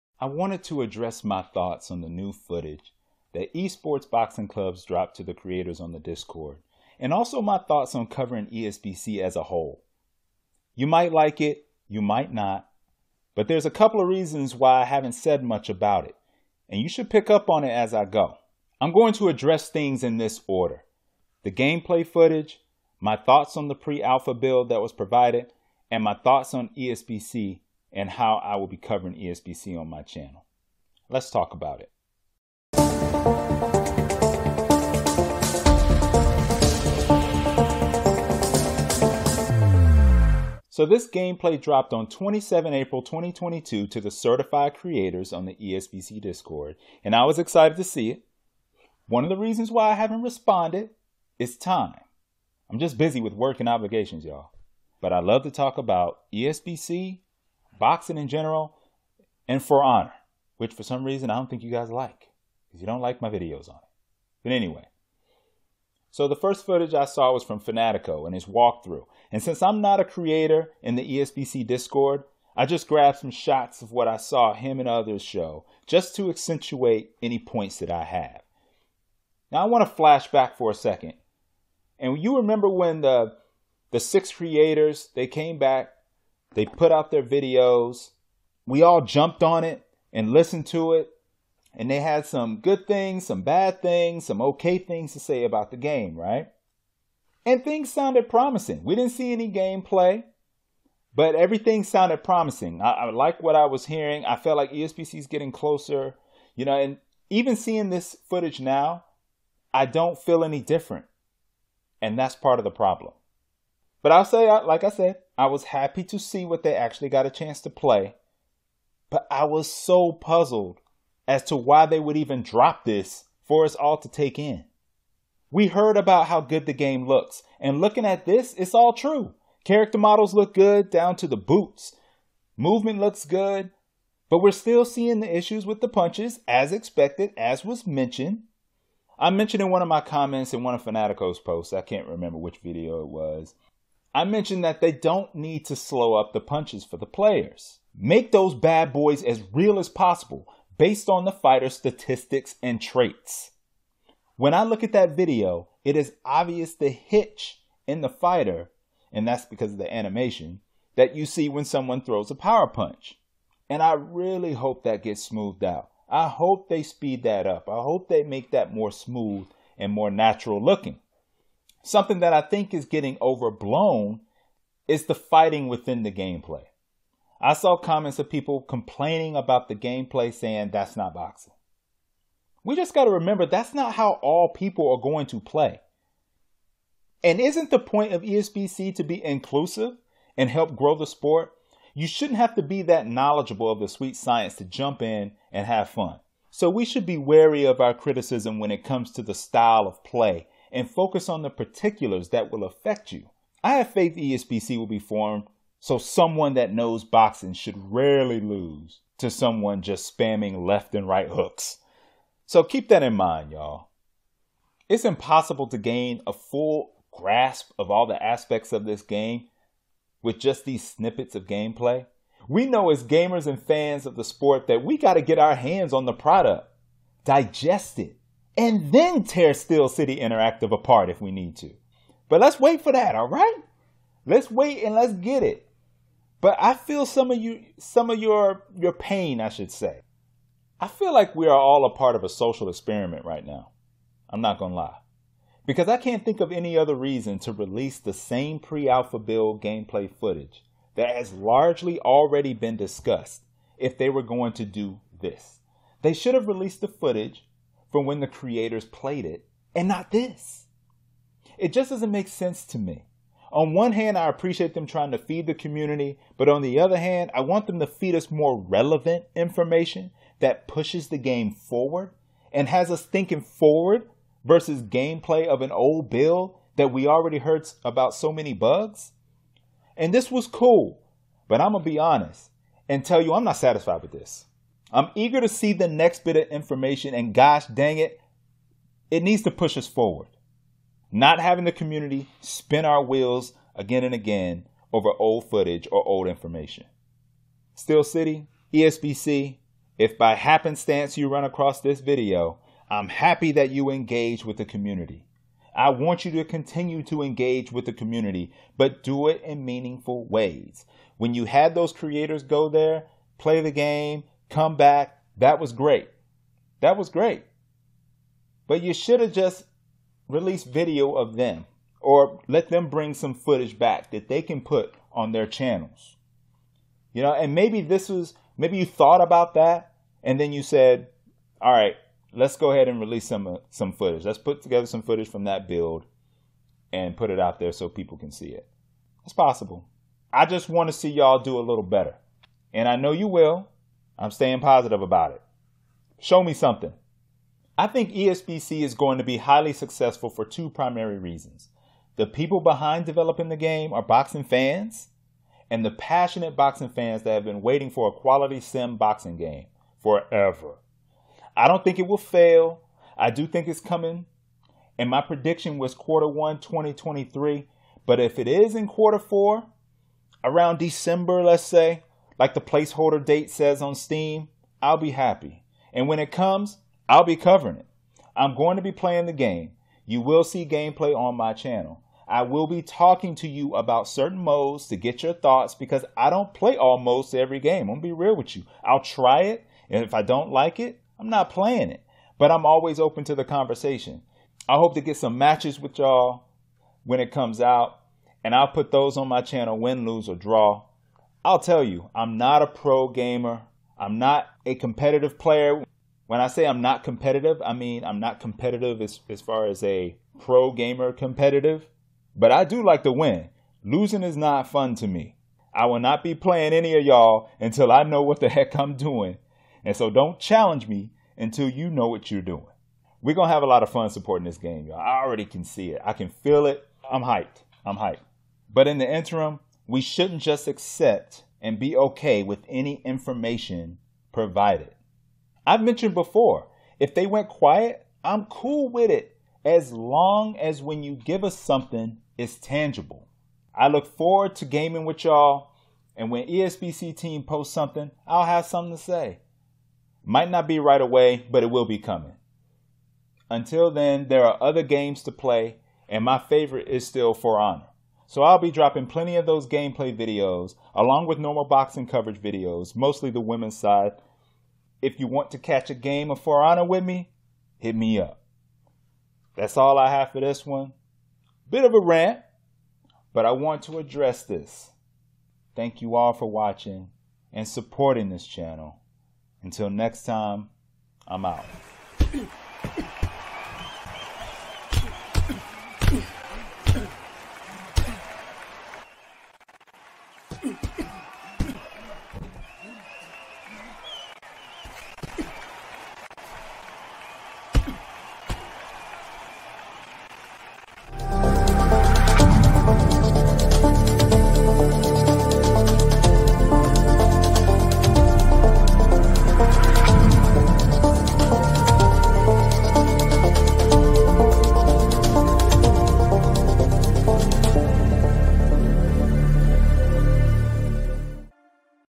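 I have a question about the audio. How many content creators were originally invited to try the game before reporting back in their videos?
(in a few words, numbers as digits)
6.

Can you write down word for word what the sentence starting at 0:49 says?
One of the reasons why I haven't responded is time.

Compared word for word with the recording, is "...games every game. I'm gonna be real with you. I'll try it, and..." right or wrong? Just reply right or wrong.
wrong.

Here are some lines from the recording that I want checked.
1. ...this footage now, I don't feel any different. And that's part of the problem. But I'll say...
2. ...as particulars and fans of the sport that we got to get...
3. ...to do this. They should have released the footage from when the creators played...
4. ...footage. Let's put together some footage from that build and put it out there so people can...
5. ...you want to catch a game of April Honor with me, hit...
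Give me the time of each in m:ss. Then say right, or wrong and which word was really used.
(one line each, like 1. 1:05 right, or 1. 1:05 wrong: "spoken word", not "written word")
1. 1:47 right
2. 3:42 wrong: "gamers", not "particulars"
3. 4:14 right
4. 5:33 right
5. 7:45 wrong: "For", not "April".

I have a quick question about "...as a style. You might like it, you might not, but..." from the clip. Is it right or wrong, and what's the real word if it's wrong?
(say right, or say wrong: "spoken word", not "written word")
wrong: "whole", not "style".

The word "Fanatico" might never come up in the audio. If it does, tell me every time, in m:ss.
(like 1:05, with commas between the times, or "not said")
1:07, 2:20.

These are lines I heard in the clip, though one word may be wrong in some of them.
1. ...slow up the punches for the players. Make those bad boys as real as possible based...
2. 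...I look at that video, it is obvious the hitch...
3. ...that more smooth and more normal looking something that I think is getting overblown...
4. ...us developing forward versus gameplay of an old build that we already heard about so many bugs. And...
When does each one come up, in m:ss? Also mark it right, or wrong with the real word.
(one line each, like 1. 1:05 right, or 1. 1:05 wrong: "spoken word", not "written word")
1. 2:25 right
2. 2:34 right
3. 2:48 wrong: "natural", not "normal"
4. 4:32 wrong: "thinking", not "developing".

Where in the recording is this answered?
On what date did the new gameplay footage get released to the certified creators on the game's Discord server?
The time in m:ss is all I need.
0:42.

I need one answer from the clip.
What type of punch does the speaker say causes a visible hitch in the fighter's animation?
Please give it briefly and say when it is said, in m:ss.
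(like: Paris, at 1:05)
Power punch, at 2:42.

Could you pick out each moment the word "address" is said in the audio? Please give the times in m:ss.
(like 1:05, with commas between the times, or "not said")
0:00, 0:19, 7:53.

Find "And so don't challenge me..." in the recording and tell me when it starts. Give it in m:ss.
6:59.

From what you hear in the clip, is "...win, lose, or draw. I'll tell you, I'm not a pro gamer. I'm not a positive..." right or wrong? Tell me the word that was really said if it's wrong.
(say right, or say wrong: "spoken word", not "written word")
wrong: "competitive", not "positive".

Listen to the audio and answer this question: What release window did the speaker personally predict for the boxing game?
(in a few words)
Quarter 1 2023.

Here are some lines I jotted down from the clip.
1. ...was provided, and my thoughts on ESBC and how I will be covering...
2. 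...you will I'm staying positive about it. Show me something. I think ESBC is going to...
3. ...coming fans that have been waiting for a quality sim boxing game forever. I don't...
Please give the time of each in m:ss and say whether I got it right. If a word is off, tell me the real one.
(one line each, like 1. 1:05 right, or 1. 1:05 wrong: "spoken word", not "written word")
1. 0:24 right
2. 5:43 right
3. 5:56 wrong: "boxing", not "coming".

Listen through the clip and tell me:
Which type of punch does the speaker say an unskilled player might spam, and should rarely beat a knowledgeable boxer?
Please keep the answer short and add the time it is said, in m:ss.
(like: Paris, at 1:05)
Left and right hooks, at 3:30.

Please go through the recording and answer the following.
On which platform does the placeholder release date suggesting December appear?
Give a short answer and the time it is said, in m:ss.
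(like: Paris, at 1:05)
Steam, at 6:13.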